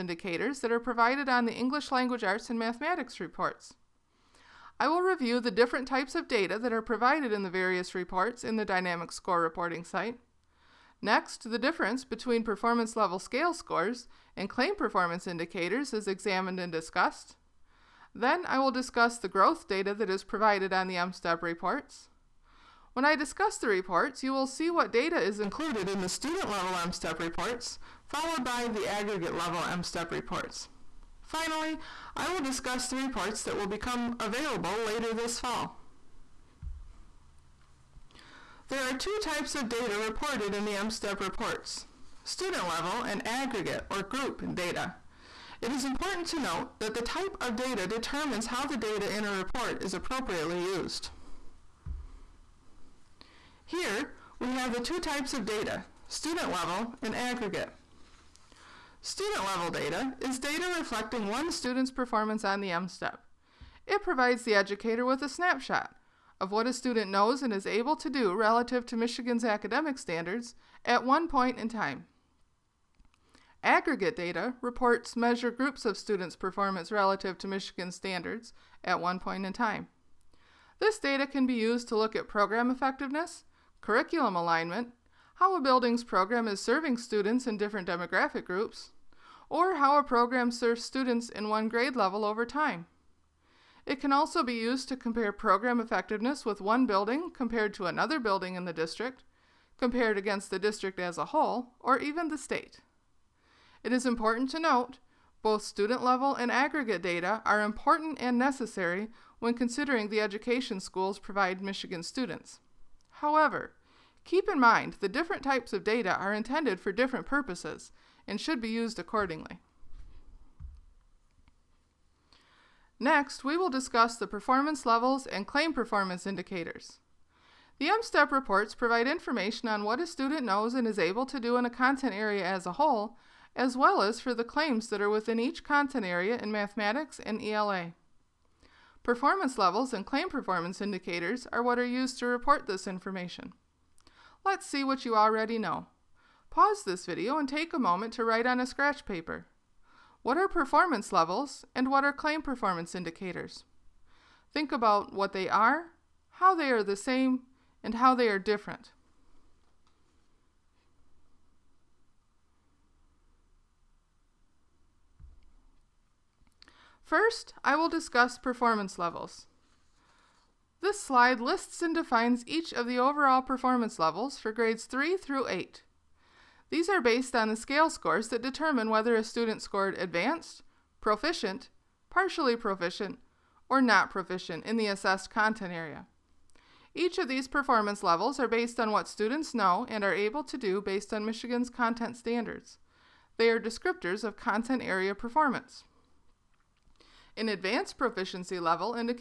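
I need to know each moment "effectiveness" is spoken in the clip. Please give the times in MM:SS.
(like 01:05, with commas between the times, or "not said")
01:22, 01:35.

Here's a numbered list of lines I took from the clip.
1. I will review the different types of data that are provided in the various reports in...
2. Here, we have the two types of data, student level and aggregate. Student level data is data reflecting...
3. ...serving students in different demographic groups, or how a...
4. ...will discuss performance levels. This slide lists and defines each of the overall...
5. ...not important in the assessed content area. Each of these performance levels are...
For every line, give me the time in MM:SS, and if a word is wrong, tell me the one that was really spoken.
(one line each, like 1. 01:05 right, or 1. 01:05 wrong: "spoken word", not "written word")
1. 00:04 right
2. 00:53 right
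3. 01:26 right
4. 02:47 right
5. 03:03 wrong: "proficient", not "important".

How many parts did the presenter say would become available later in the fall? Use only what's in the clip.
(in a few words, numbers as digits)
3.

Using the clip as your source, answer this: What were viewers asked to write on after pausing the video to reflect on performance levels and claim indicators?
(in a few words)
scratch paper.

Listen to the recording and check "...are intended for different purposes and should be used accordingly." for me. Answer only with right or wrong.
right.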